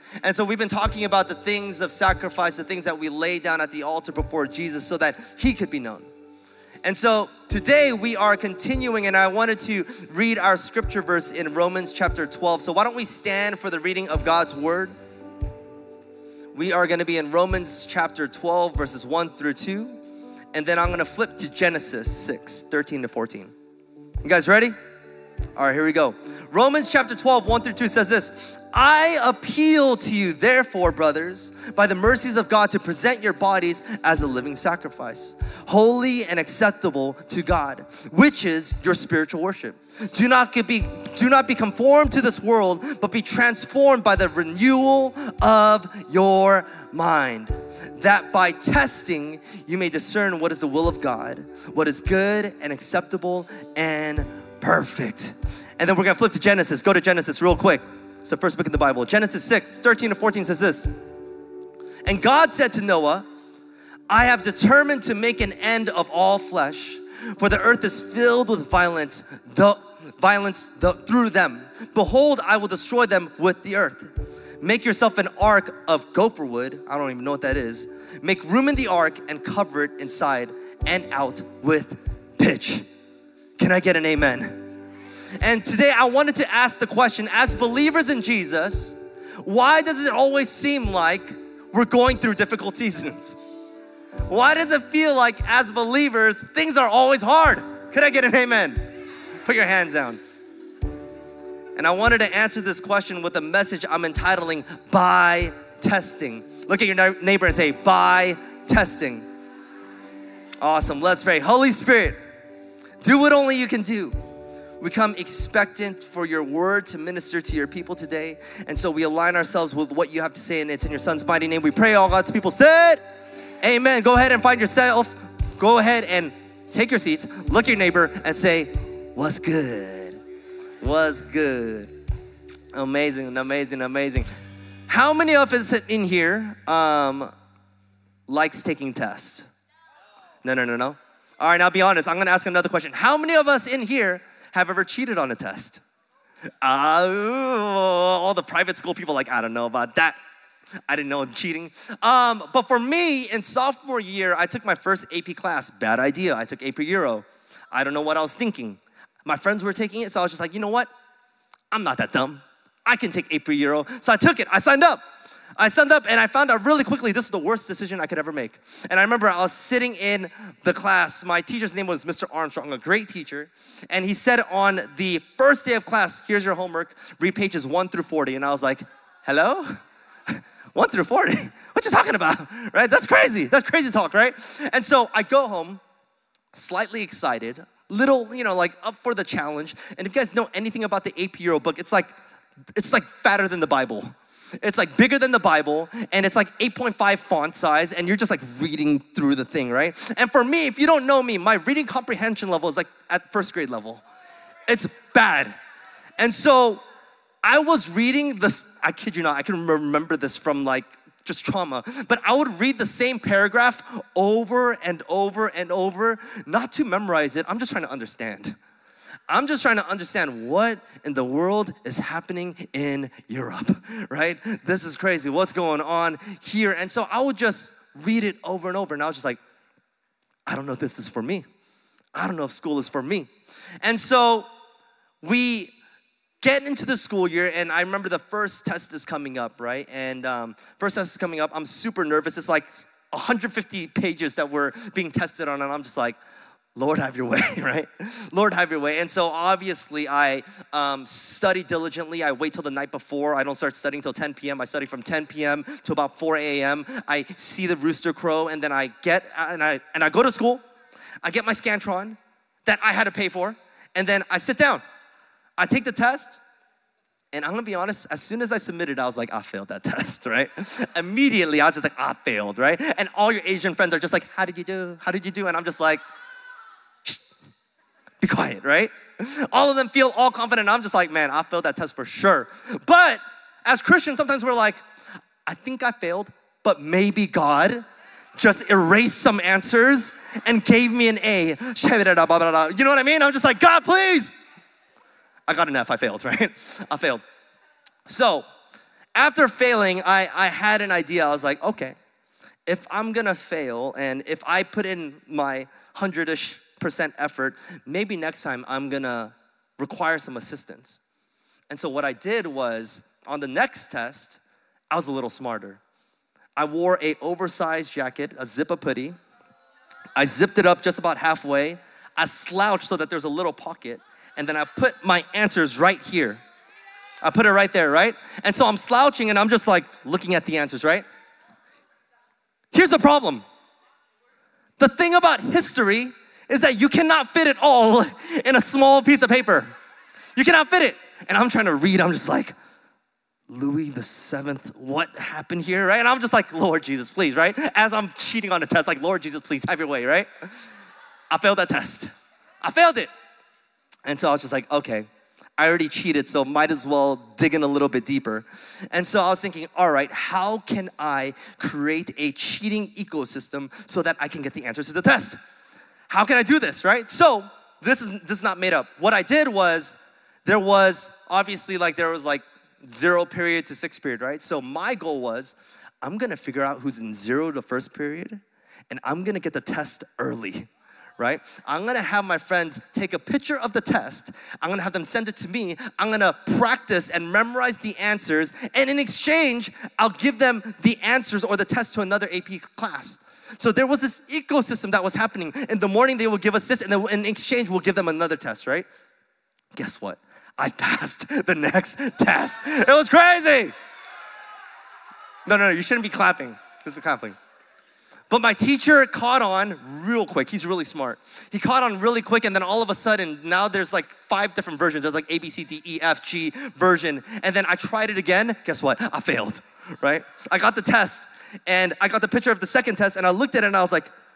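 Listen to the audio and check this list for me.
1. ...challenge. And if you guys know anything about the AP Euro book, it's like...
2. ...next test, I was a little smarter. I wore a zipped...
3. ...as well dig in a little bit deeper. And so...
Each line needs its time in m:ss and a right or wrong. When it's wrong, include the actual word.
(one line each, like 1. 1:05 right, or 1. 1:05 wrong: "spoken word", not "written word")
1. 3:09 right
2. 5:13 wrong: "oversized", not "zipped"
3. 5:56 right.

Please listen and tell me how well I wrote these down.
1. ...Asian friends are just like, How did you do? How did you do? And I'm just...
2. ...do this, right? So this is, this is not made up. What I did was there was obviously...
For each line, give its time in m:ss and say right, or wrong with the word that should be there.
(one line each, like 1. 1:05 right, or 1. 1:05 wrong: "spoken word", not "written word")
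1. 4:33 right
2. 6:06 right.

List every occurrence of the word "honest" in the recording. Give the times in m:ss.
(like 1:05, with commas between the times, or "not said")
2:21, 4:27.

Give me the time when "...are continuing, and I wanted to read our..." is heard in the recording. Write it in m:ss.
0:08.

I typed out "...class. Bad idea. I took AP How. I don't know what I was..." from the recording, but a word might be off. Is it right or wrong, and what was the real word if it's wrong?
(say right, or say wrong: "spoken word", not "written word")
wrong: "Euro", not "How".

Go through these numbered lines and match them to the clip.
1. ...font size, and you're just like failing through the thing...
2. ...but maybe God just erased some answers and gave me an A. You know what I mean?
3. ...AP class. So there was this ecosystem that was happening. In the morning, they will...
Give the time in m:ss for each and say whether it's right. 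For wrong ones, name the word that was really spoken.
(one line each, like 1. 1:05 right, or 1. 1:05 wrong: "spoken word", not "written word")
1. 3:17 wrong: "reading", not "failing"
2. 4:46 right
3. 6:32 right.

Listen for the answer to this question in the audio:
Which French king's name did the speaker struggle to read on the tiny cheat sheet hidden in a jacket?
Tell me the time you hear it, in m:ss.
5:43.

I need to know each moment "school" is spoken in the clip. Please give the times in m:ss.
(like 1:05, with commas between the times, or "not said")
2:28, 3:52, 3:56, 4:20.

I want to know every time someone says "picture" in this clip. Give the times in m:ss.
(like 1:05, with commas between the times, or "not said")
6:23, 7:02.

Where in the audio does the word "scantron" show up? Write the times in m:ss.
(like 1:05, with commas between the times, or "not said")
4:21.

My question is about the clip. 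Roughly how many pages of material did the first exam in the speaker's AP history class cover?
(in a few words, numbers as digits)
150.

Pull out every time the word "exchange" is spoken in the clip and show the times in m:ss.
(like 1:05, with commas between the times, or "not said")
6:28, 6:37.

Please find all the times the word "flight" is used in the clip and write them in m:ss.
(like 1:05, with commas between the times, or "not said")
not said.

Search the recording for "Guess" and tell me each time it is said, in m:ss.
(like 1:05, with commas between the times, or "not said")
6:39, 6:58.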